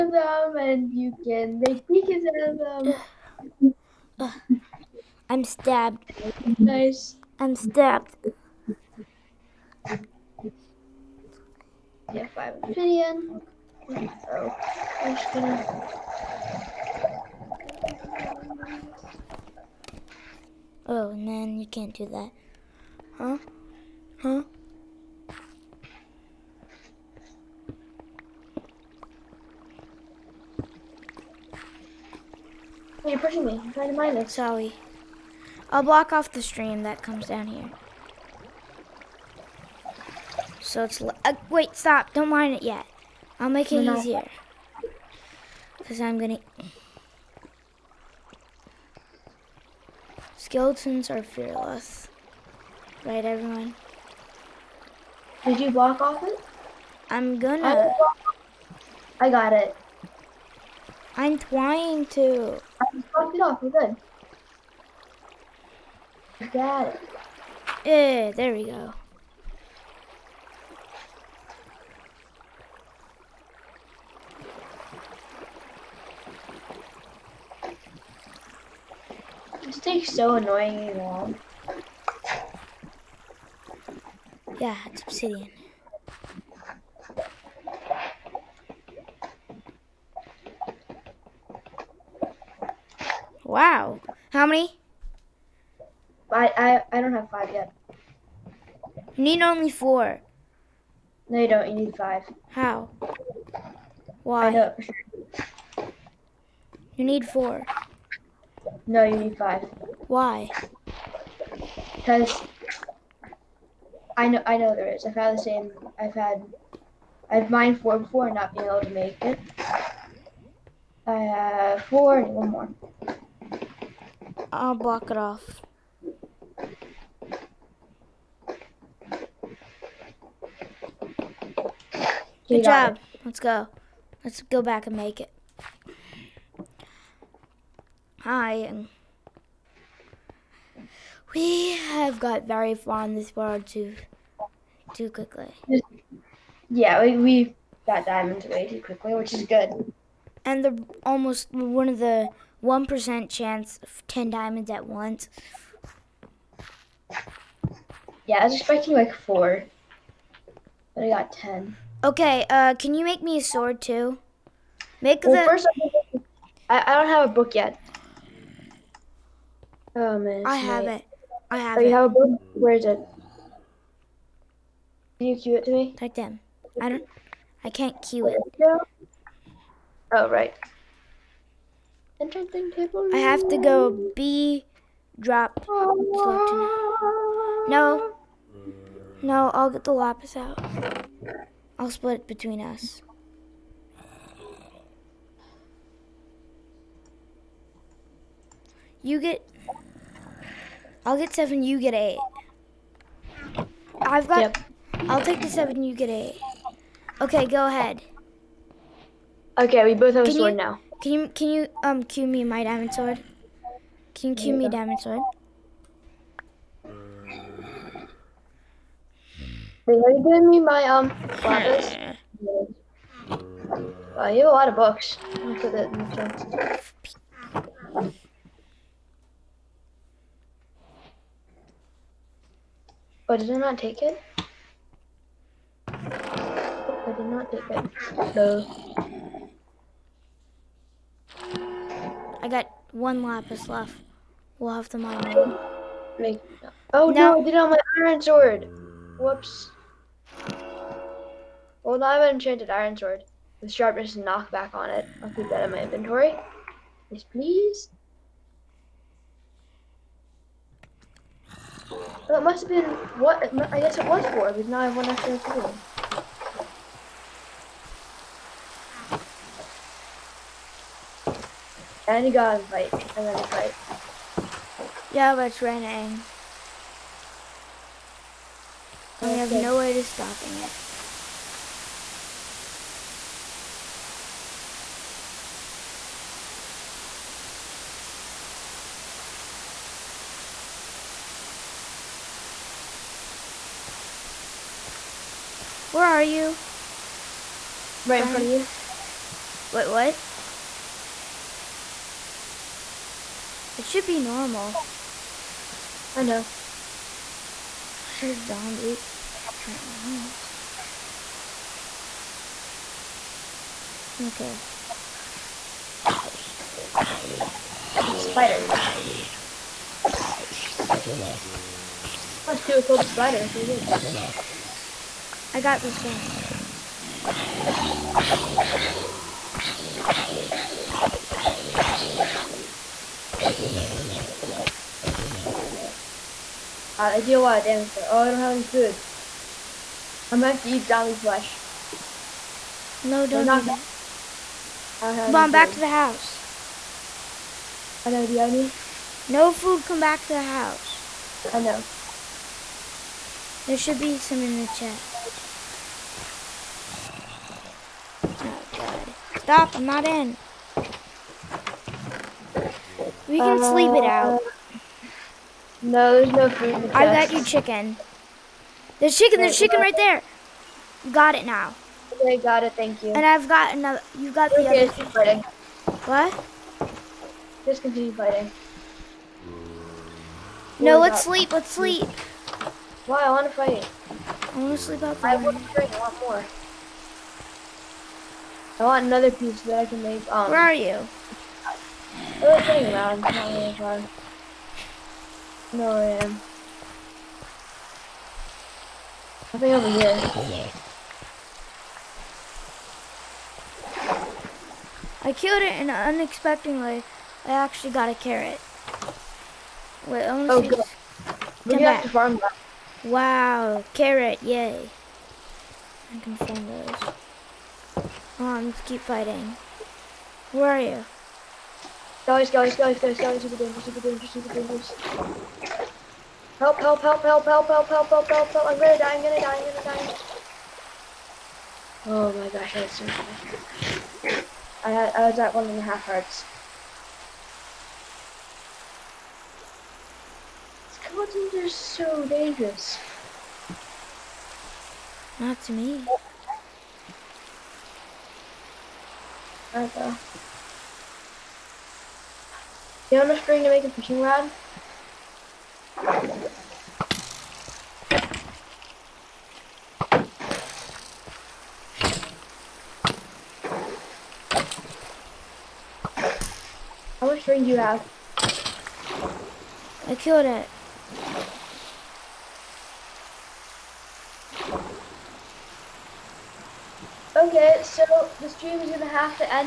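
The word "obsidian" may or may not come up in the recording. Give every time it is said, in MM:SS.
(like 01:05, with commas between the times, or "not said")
00:12, 01:25.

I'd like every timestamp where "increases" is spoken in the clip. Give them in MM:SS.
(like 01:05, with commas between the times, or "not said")
not said.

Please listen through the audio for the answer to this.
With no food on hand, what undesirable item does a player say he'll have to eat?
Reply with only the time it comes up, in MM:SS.
05:40.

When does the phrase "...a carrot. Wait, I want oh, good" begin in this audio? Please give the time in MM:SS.
06:48.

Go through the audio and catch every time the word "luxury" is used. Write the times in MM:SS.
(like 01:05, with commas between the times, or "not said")
not said.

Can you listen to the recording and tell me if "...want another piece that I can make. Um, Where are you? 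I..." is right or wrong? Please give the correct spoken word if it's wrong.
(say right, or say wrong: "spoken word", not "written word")
right.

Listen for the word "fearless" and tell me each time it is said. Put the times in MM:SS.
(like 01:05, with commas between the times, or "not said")
00:51.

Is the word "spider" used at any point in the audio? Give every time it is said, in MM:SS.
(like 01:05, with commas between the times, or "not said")
05:18, 05:22.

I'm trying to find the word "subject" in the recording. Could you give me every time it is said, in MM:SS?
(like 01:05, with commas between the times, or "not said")
not said.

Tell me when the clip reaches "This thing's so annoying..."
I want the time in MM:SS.
01:19.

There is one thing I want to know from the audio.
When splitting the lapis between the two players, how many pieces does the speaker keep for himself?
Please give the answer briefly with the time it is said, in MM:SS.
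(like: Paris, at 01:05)
7, at 03:25.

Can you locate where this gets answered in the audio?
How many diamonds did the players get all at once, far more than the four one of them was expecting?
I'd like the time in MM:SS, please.
02:34.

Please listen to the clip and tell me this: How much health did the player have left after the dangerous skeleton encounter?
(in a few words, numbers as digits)
One and a half hearts.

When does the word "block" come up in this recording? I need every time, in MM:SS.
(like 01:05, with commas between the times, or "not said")
00:35, 00:55, 02:04.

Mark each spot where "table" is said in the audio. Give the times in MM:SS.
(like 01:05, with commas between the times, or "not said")
03:02.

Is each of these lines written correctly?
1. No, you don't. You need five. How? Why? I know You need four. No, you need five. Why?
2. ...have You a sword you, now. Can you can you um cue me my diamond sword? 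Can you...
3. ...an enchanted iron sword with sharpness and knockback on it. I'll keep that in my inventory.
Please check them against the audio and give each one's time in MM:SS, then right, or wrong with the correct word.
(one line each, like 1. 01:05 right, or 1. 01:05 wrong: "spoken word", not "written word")
1. 01:41 right
2. 03:30 wrong: "Can", not "You"
3. 04:12 right.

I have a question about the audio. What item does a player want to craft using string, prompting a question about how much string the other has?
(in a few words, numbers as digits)
Fishing rod.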